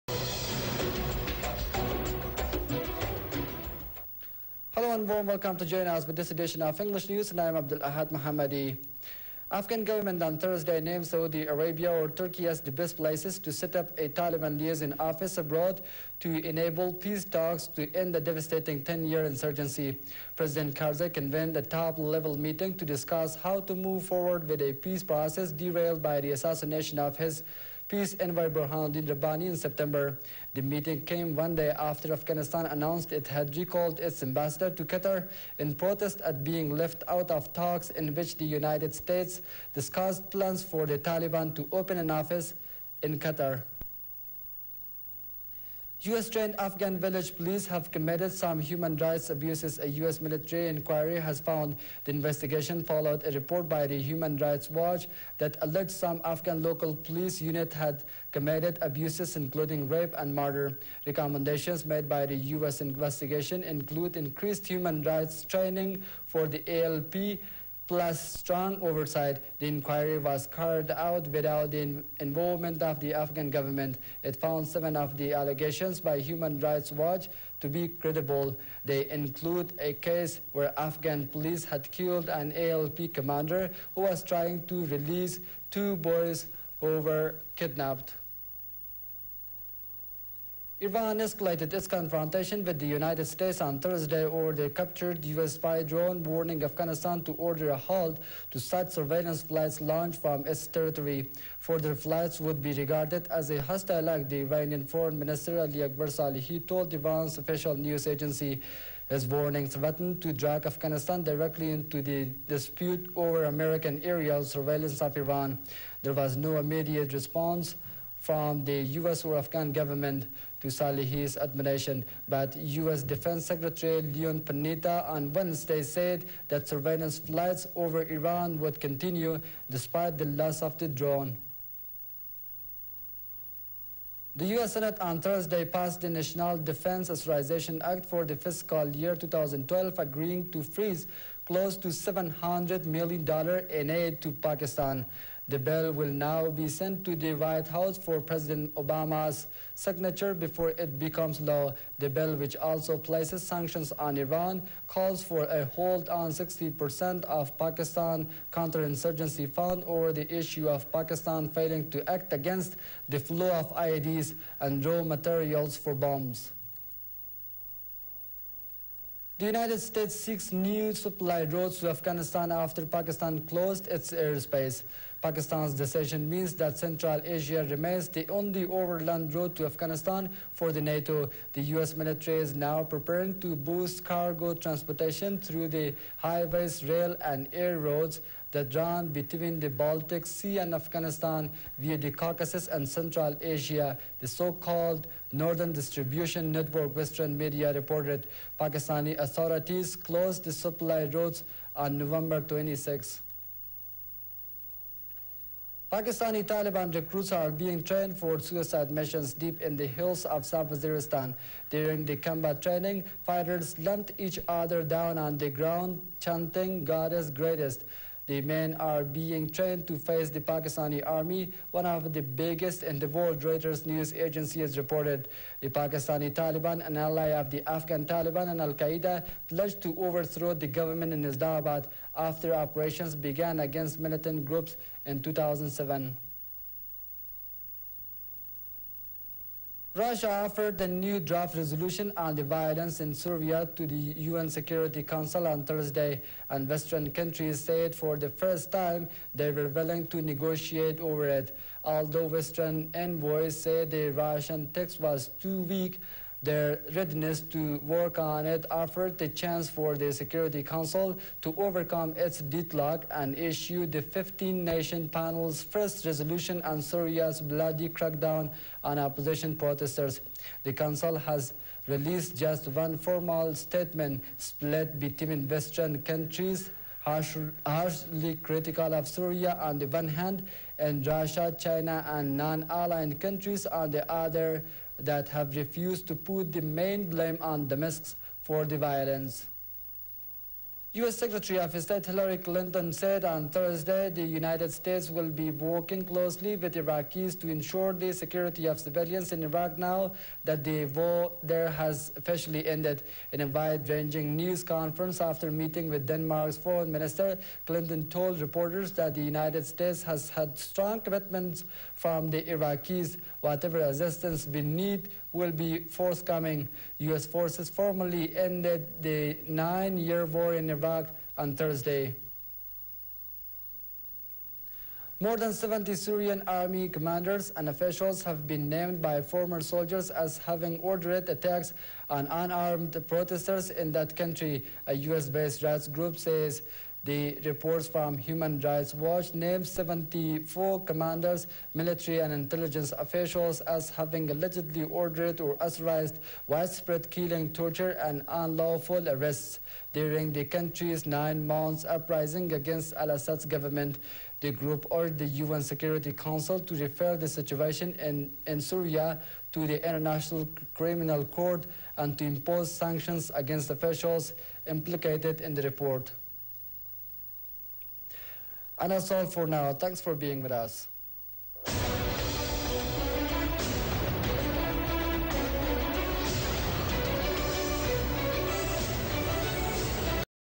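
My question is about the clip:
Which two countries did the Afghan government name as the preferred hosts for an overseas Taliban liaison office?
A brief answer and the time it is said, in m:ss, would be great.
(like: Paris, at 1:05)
Saudi Arabia or Turkey, at 0:11.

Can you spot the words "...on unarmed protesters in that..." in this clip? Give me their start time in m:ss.
5:32.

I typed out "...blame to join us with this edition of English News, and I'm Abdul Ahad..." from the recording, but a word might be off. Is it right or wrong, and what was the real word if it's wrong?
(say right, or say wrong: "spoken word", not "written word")
wrong: "welcome", not "blame".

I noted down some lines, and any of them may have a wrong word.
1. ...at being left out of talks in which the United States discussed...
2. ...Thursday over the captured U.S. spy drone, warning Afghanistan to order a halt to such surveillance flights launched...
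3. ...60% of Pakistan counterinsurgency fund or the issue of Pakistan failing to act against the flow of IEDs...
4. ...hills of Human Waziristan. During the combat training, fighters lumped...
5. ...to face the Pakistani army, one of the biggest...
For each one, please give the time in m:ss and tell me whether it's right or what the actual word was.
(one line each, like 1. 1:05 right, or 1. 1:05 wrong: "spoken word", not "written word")
1. 0:36 right
2. 1:33 right
3. 2:36 right
4. 3:29 wrong: "South", not "Human"
5. 3:39 right.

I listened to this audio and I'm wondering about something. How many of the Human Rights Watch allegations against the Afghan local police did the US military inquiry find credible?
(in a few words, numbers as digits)
7.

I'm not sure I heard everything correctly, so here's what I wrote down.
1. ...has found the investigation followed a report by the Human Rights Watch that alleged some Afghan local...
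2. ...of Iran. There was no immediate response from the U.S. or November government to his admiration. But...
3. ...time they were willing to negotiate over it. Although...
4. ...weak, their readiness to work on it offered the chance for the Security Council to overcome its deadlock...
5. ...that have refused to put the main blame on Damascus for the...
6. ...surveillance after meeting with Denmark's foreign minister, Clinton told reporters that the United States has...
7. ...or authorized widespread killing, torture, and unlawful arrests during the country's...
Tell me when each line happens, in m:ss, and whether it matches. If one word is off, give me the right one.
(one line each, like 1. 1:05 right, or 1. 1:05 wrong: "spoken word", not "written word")
1. 0:51 right
2. 1:54 wrong: "Afghan", not "November"
3. 4:08 right
4. 4:15 right
5. 4:45 right
6. 5:04 wrong: "conference", not "surveillance"
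7. 5:45 right.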